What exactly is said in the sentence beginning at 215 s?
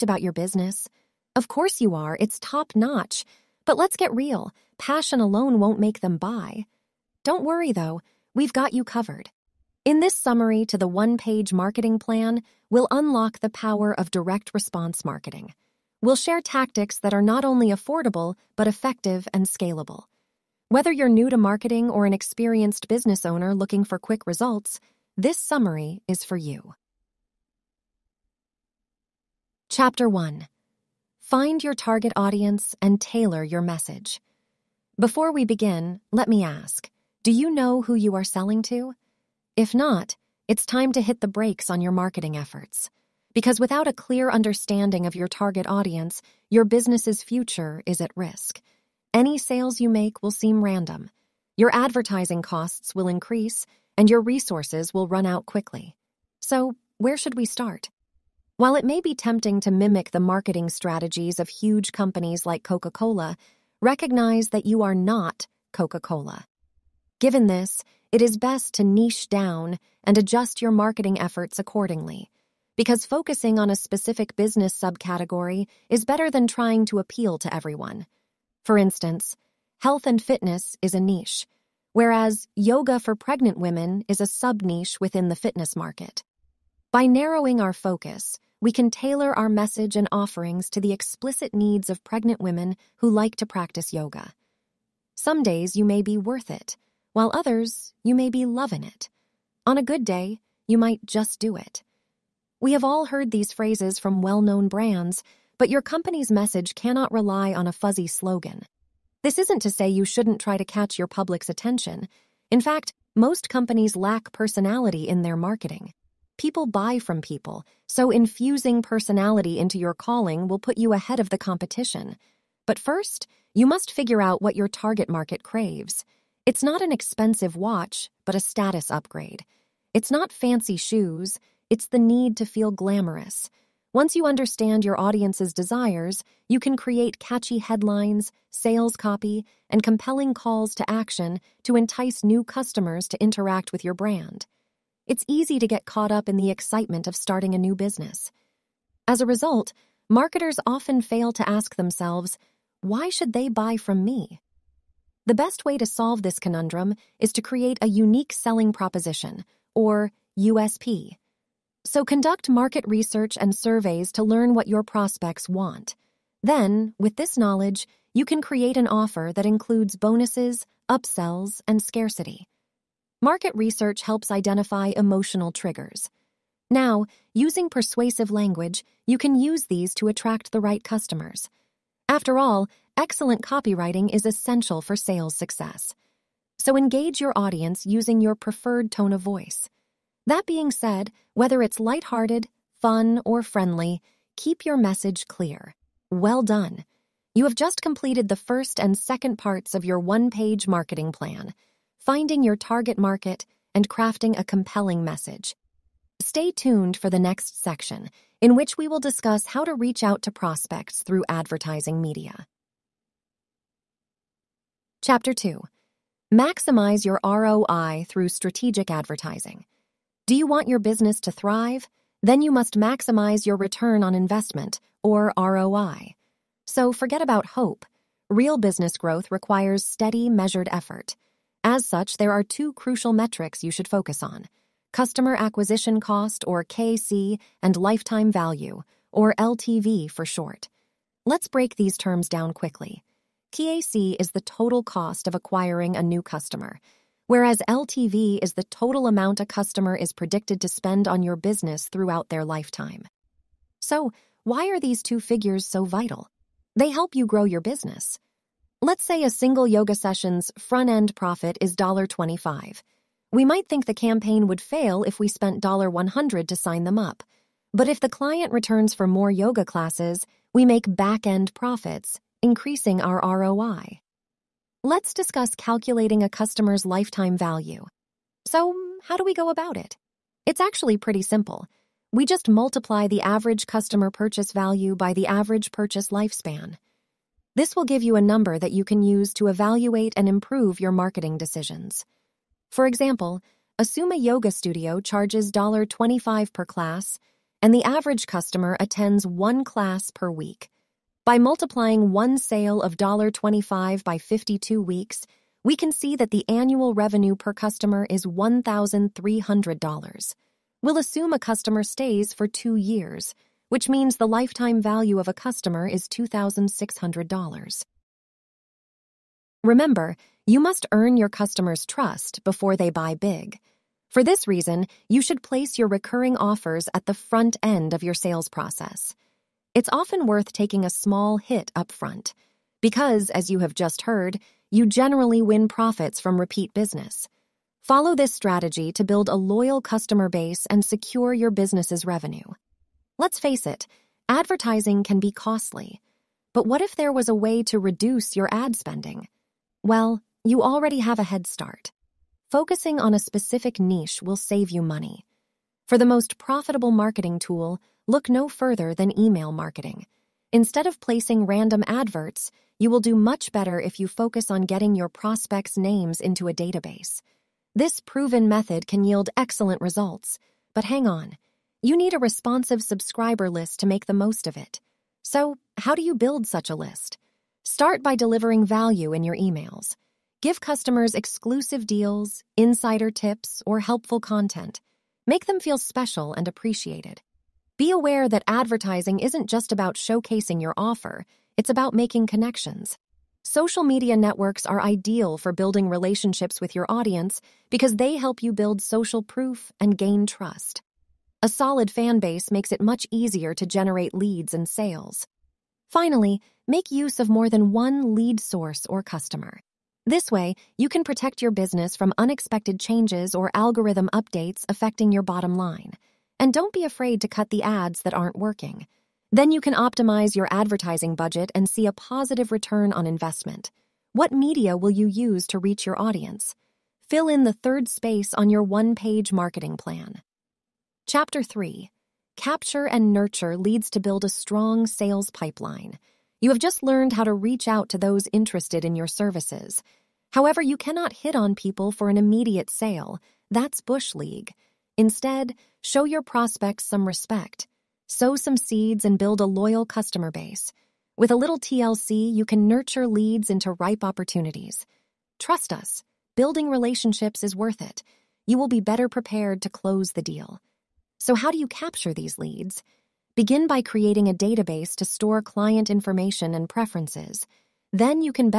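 Chapter 2 Maximize your ROI through strategic advertising.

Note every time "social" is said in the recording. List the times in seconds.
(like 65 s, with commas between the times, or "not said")
393 s, 398 s.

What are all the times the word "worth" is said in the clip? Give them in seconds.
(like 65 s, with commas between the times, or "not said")
96 s, 330 s, 457 s.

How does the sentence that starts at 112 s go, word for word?
In fact, most companies lack personality in their marketing.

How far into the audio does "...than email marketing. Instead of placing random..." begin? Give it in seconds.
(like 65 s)
358 s.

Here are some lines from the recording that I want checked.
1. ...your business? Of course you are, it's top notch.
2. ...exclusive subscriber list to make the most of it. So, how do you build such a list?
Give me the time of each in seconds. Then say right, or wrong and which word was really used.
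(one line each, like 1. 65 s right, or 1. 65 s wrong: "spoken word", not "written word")
1. 0 s right
2. 372 s wrong: "responsive", not "exclusive".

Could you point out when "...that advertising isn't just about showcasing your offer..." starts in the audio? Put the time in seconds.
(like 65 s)
388 s.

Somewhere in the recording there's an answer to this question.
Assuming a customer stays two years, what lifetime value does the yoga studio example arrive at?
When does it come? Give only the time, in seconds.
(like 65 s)
316 s.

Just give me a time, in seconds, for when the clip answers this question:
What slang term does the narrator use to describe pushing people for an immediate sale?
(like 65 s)
443 s.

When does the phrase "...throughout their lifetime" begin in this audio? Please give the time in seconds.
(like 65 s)
251 s.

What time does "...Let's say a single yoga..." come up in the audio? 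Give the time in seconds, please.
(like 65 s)
258 s.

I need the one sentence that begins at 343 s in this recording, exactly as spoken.
Let's face it, advertising can be costly.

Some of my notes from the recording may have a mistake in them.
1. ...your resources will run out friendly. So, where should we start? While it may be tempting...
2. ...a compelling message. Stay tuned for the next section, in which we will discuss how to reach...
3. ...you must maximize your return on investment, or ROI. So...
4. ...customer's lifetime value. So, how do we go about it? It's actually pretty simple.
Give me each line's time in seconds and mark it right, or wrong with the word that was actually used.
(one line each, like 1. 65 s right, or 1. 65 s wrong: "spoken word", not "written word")
1. 54 s wrong: "quickly", not "friendly"
2. 204 s right
3. 222 s right
4. 276 s right.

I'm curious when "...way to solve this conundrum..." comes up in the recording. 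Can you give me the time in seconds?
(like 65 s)
155 s.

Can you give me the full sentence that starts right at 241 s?
Let's break these terms down quickly.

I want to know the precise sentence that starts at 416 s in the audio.
And don't be afraid to cut the ads that aren't working.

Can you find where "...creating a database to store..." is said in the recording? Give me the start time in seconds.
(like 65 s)
463 s.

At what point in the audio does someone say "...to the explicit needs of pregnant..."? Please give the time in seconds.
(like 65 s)
90 s.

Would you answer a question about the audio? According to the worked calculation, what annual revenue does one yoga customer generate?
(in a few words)
$1,300.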